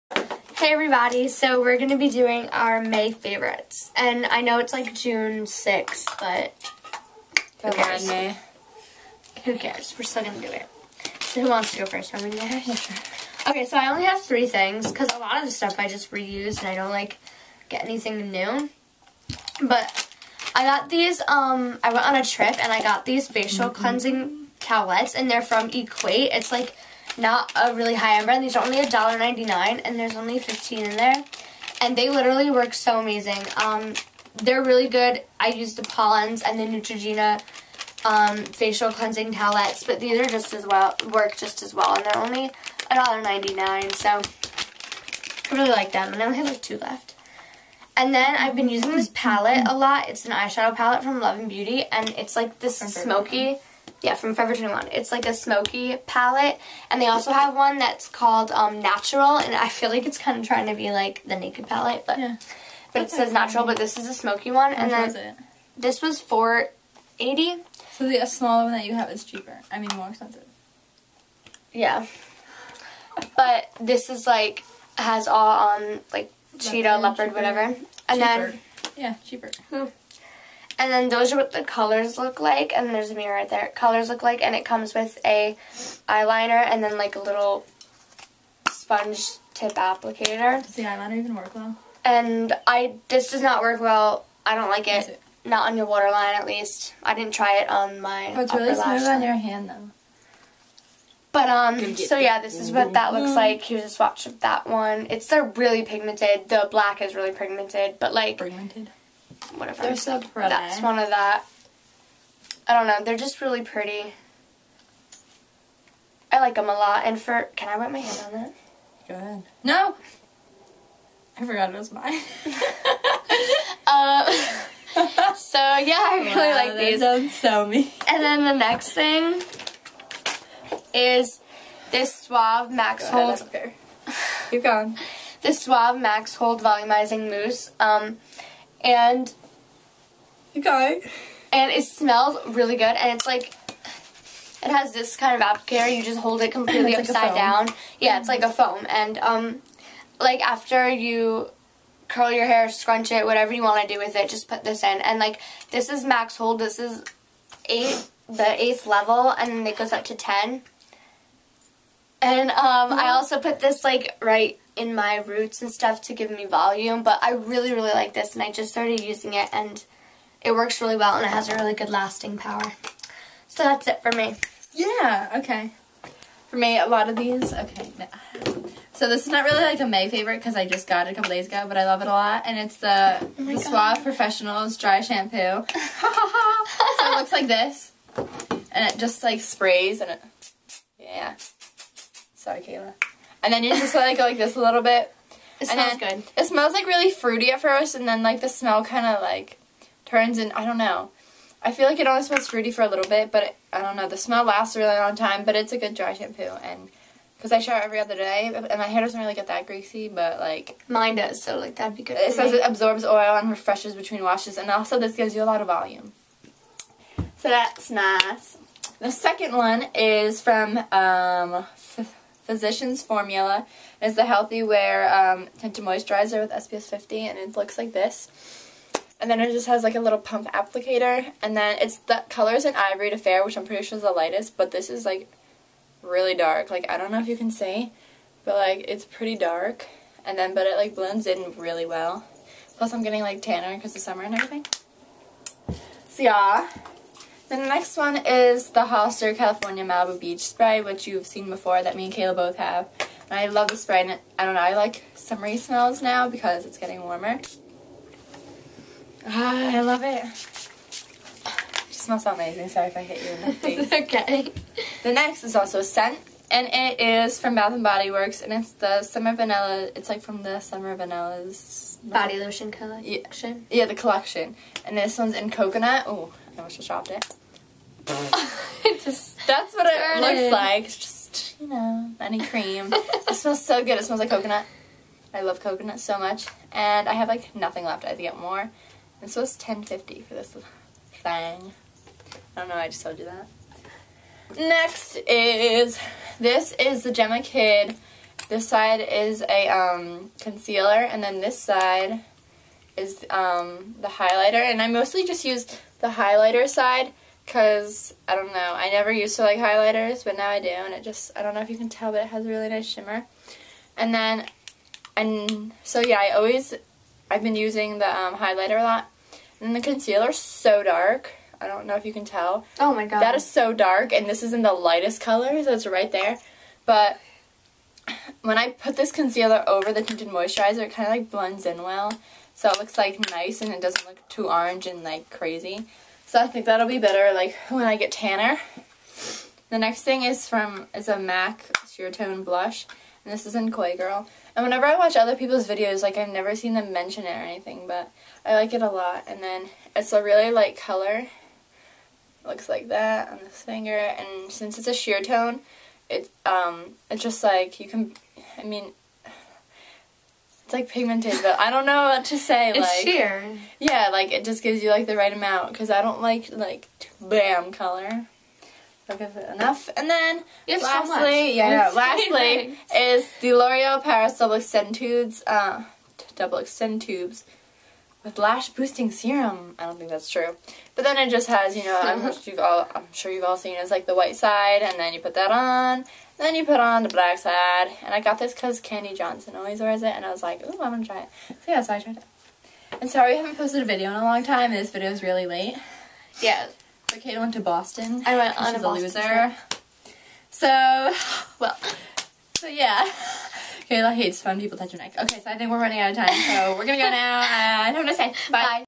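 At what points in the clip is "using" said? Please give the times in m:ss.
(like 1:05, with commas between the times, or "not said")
0:48, 2:49, 5:17.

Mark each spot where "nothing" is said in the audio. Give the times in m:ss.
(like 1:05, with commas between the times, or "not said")
4:47.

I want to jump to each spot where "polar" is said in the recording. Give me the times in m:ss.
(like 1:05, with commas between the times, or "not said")
not said.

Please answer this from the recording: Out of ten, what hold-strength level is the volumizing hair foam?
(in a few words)
8.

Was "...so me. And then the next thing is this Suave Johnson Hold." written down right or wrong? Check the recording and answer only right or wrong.
wrong.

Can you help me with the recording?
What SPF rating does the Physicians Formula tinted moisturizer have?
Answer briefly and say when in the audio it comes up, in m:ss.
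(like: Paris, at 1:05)
SPF 50, at 3:46.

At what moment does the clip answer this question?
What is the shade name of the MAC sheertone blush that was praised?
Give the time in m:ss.
5:43.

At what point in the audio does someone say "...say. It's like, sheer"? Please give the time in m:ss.
6:02.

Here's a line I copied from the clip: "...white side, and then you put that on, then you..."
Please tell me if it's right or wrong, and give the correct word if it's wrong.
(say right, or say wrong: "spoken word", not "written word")
right.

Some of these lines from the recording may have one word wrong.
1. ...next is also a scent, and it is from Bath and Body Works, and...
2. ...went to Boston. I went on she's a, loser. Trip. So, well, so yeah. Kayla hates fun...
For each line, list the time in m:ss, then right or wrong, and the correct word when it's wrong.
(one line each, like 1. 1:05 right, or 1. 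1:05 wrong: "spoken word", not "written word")
1. 4:25 right
2. 6:37 right.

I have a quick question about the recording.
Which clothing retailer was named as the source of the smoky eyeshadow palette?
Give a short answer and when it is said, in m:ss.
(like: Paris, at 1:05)
Forever 21, at 0:54.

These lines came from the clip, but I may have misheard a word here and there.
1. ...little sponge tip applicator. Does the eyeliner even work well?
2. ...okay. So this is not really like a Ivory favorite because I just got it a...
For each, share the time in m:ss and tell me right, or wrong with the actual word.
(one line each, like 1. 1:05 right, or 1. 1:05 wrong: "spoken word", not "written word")
1. 1:27 right
2. 2:57 wrong: "May", not "Ivory".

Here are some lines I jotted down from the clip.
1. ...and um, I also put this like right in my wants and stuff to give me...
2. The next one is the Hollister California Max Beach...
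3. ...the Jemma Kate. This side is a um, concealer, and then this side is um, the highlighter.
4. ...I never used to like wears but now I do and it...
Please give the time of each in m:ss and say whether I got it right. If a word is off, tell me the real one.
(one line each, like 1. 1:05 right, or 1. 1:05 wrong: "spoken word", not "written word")
1. 2:42 wrong: "roots", not "wants"
2. 4:07 wrong: "Malibu", not "Max"
3. 4:57 wrong: "Kidd", not "Kate"
4. 5:08 wrong: "highlighters", not "wears".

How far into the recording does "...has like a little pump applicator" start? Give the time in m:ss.
3:49.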